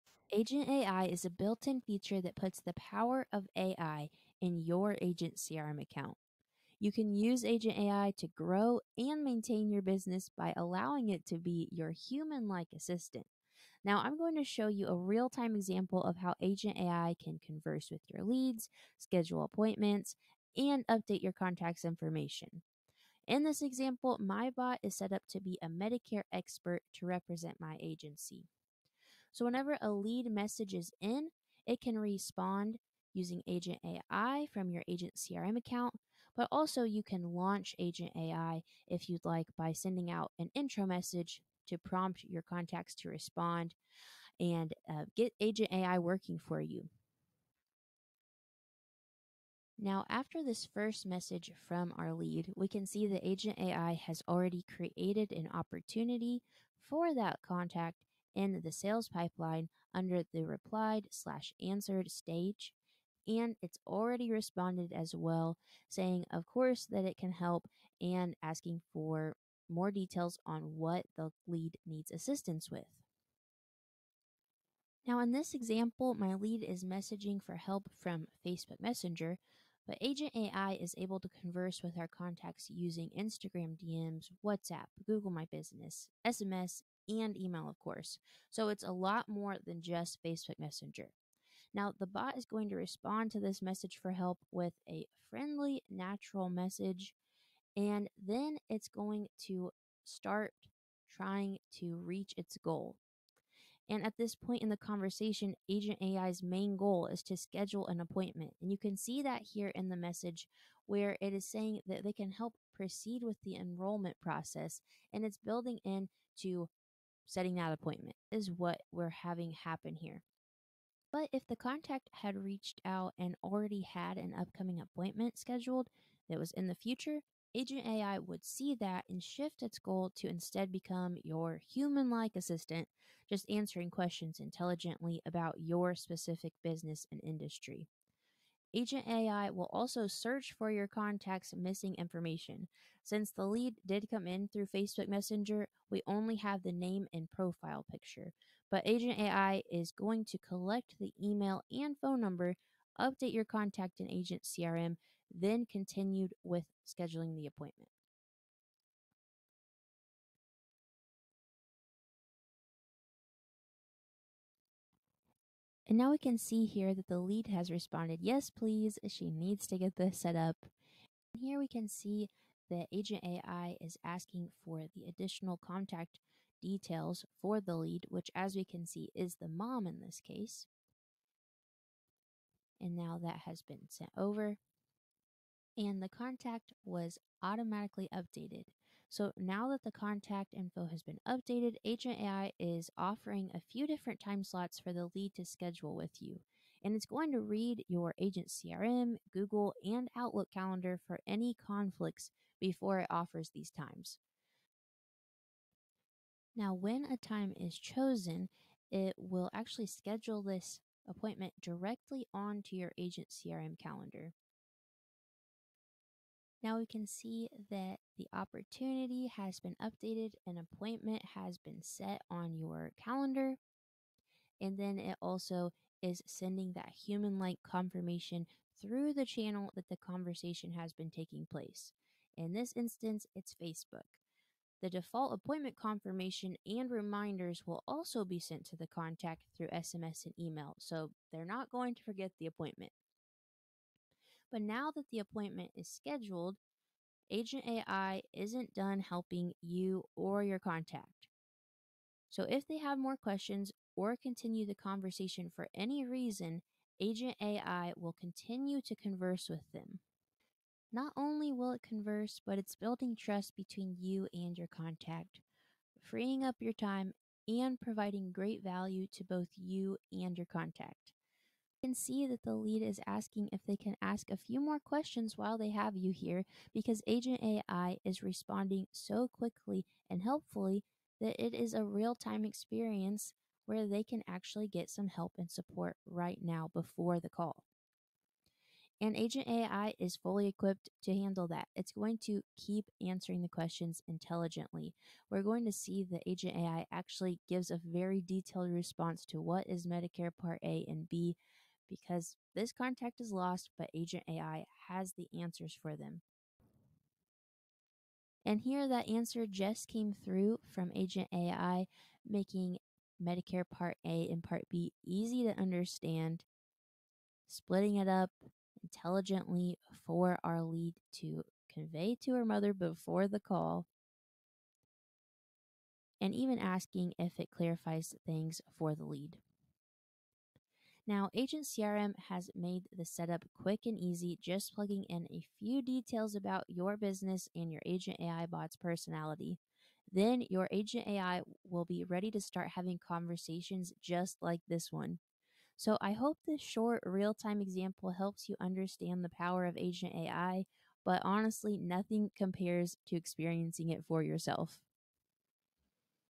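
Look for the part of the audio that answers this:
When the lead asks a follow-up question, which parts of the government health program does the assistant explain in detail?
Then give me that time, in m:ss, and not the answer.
4:59.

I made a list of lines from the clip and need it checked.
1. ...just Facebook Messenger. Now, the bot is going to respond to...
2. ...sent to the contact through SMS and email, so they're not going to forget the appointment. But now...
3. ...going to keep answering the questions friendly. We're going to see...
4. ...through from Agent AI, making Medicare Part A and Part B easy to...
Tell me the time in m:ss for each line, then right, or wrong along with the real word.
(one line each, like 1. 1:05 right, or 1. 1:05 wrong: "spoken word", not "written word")
1. 1:29 right
2. 3:58 right
3. 4:51 wrong: "intelligently", not "friendly"
4. 5:10 right.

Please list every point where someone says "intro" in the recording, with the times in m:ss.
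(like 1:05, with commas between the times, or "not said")
0:40.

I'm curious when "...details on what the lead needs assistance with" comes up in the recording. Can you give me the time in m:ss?
1:09.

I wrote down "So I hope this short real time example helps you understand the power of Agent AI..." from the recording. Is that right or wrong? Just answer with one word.
right.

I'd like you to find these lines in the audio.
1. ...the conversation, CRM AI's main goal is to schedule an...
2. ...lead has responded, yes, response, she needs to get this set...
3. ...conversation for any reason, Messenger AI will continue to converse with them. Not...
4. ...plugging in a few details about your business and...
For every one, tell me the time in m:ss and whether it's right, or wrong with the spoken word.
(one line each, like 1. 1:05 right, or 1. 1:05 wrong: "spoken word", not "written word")
1. 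1:44 wrong: "Agent", not "CRM"
2. 2:47 wrong: "please", not "response"
3. 4:14 wrong: "Agent", not "Messenger"
4. 5:34 right.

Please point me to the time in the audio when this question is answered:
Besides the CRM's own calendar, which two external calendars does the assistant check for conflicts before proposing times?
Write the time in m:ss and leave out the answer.
3:19.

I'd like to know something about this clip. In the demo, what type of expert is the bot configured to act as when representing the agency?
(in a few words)
Medicare expert.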